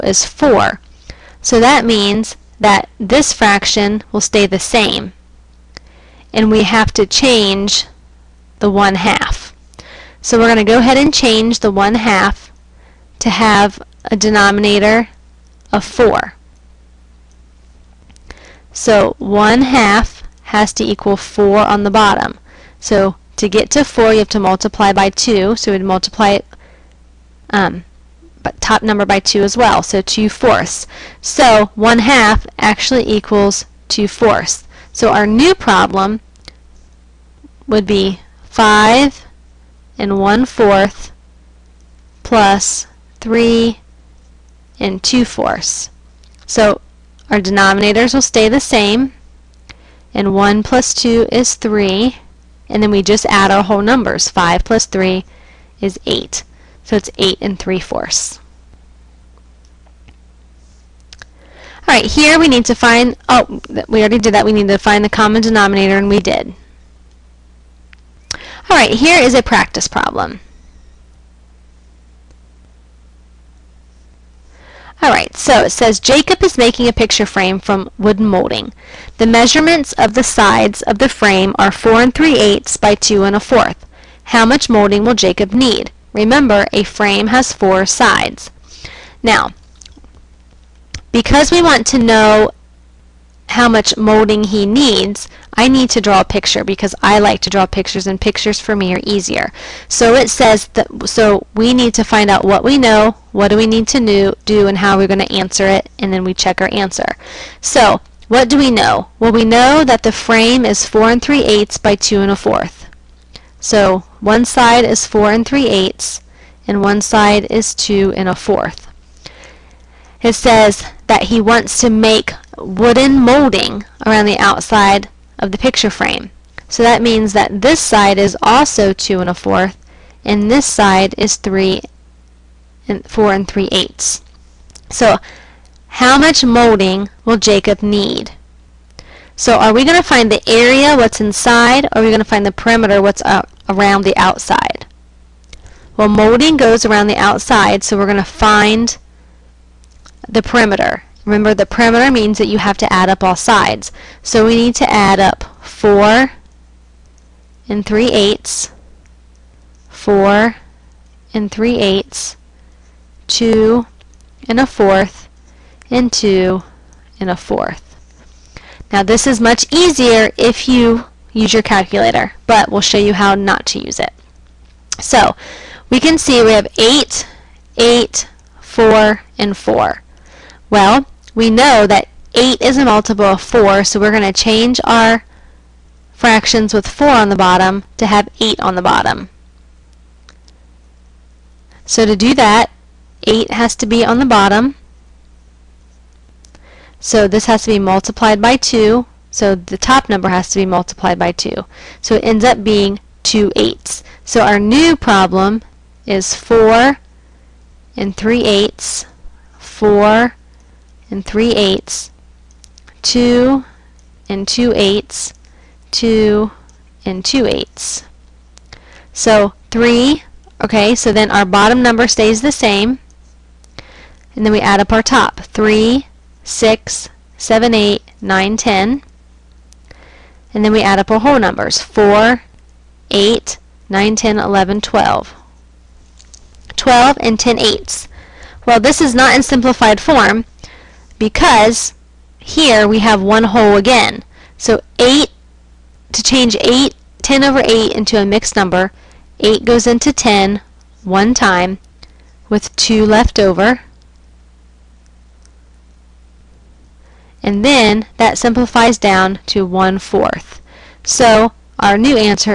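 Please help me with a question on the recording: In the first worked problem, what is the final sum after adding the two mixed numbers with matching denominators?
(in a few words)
8 and 3/4.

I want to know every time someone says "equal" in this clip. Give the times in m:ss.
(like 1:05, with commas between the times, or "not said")
0:20, 0:33.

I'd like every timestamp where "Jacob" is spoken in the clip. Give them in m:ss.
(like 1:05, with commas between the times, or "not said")
1:15, 1:25, 2:17.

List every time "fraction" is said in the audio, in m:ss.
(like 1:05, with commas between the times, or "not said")
0:03, 3:06.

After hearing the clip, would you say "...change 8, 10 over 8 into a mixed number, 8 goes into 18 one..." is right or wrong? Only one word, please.
wrong.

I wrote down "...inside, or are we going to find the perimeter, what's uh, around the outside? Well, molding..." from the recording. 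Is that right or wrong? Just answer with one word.
right.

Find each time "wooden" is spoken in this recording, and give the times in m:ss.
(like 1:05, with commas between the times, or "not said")
1:17, 2:02.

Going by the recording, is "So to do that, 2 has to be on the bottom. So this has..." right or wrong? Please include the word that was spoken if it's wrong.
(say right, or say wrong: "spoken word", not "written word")
wrong: "8", not "2".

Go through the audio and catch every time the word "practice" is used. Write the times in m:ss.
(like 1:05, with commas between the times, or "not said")
1:09.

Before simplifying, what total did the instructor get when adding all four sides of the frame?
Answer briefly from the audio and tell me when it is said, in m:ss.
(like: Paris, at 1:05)
12 and 10/8, at 3:56.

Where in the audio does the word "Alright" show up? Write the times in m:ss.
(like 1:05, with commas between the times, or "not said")
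1:01, 1:08, 1:15.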